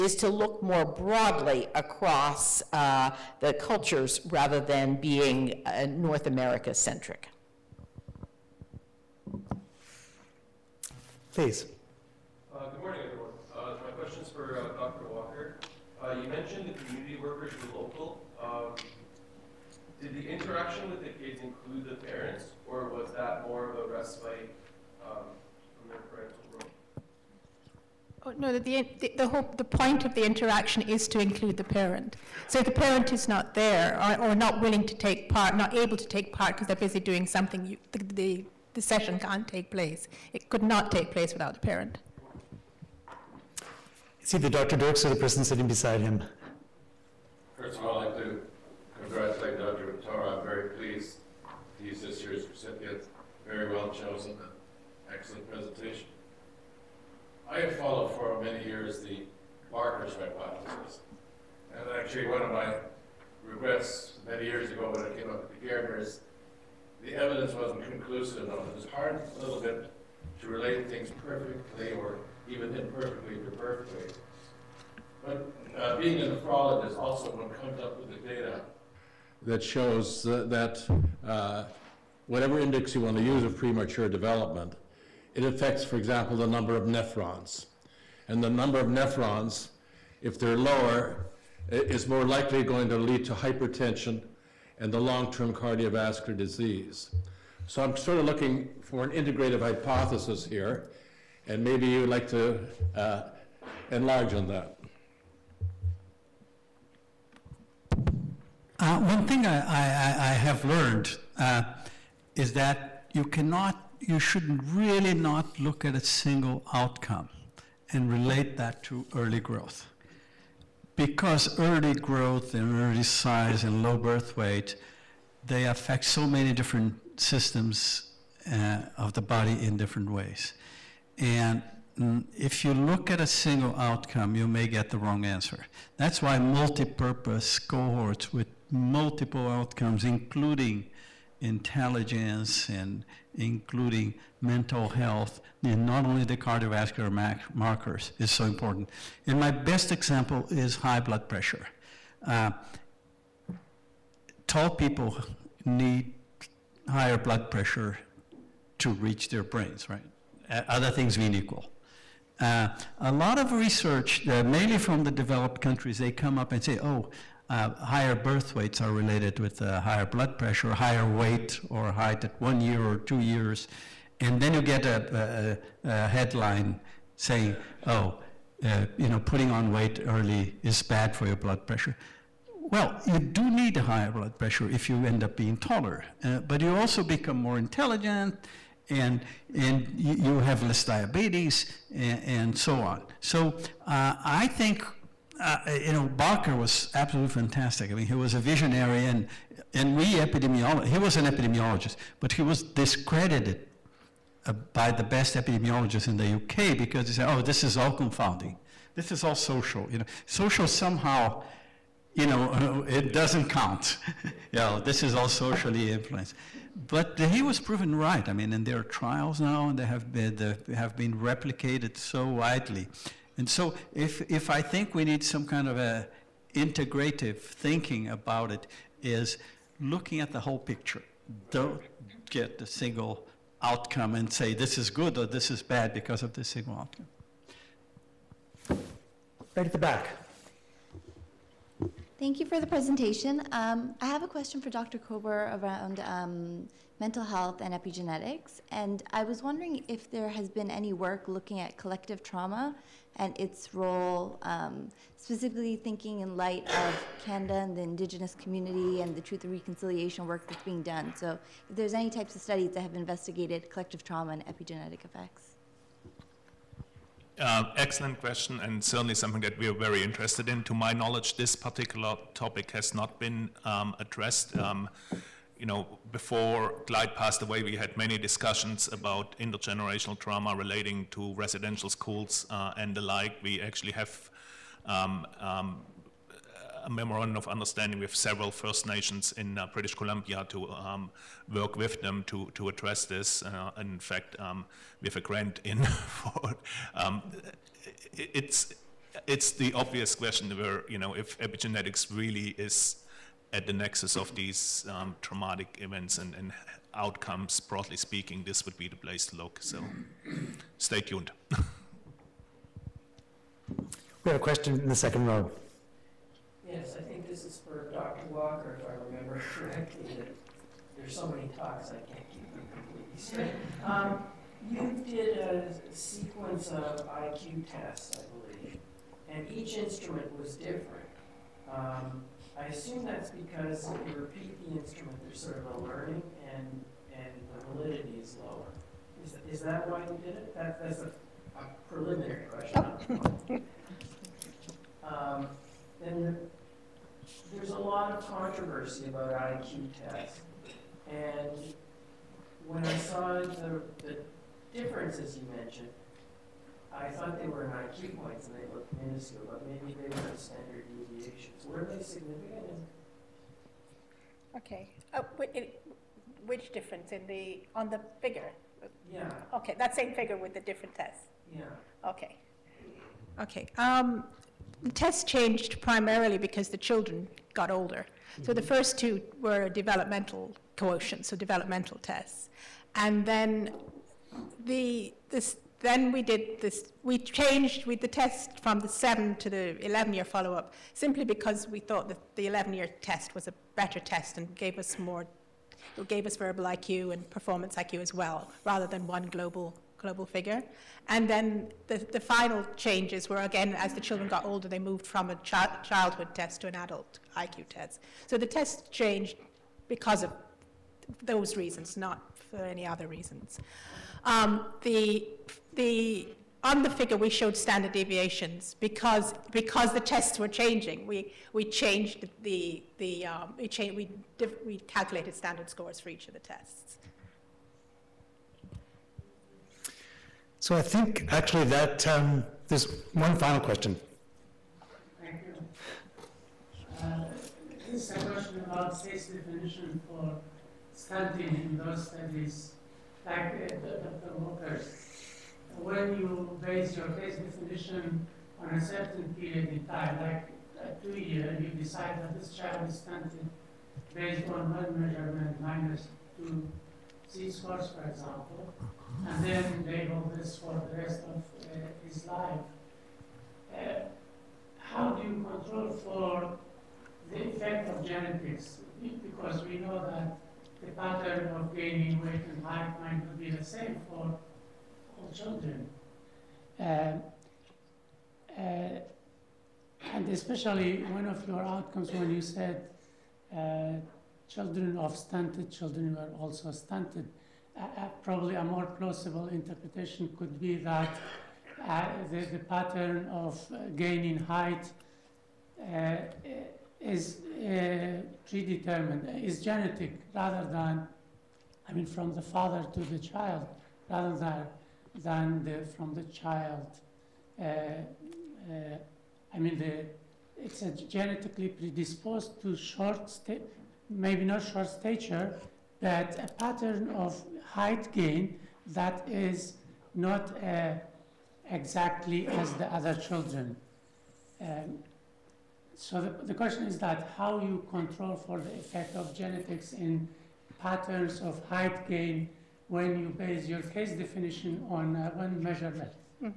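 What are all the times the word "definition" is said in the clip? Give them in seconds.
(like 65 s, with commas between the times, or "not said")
439 s, 447 s, 534 s.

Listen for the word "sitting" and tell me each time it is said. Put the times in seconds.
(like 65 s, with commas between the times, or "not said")
45 s.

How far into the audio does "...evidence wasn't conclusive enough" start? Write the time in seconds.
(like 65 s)
67 s.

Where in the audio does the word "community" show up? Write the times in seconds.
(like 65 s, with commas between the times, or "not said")
16 s, 258 s.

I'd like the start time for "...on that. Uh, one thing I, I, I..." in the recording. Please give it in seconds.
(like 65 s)
104 s.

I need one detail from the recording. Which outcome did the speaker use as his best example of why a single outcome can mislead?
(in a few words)
high blood pressure.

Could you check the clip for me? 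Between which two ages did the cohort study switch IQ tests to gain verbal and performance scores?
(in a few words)
7 and 11.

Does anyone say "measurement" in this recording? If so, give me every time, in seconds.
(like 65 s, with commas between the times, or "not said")
455 s, 535 s.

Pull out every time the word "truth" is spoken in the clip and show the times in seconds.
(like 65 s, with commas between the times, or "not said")
259 s.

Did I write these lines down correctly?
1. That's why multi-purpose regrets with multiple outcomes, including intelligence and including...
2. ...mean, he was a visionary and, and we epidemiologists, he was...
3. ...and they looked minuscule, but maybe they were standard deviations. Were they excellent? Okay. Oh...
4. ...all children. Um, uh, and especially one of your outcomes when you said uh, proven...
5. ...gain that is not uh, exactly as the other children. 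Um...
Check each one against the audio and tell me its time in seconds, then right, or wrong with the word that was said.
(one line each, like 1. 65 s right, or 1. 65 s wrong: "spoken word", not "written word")
1. 135 s wrong: "cohorts", not "regrets"
2. 197 s right
3. 358 s wrong: "significant", not "excellent"
4. 475 s wrong: "children", not "proven"
5. 518 s right.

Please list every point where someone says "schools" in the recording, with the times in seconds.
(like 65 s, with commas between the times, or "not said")
281 s.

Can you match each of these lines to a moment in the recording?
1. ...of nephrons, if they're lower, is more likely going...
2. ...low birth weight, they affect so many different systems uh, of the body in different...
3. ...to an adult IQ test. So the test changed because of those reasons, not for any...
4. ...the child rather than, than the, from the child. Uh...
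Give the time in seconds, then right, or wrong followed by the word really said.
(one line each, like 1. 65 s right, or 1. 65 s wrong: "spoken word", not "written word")
1. 88 s right
2. 123 s right
3. 406 s right
4. 503 s right.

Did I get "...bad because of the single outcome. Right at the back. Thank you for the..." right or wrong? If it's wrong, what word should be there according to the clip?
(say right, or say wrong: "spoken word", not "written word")
right.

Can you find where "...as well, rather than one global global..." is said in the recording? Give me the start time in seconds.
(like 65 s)
398 s.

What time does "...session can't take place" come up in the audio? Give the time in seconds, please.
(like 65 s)
38 s.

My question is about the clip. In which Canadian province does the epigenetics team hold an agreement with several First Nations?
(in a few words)
British Columbia.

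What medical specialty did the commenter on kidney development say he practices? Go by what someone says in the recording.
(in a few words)
nephrologist.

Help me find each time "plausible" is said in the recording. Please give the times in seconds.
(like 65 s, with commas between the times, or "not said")
488 s.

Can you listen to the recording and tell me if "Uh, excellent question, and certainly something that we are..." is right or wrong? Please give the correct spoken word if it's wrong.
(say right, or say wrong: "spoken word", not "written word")
right.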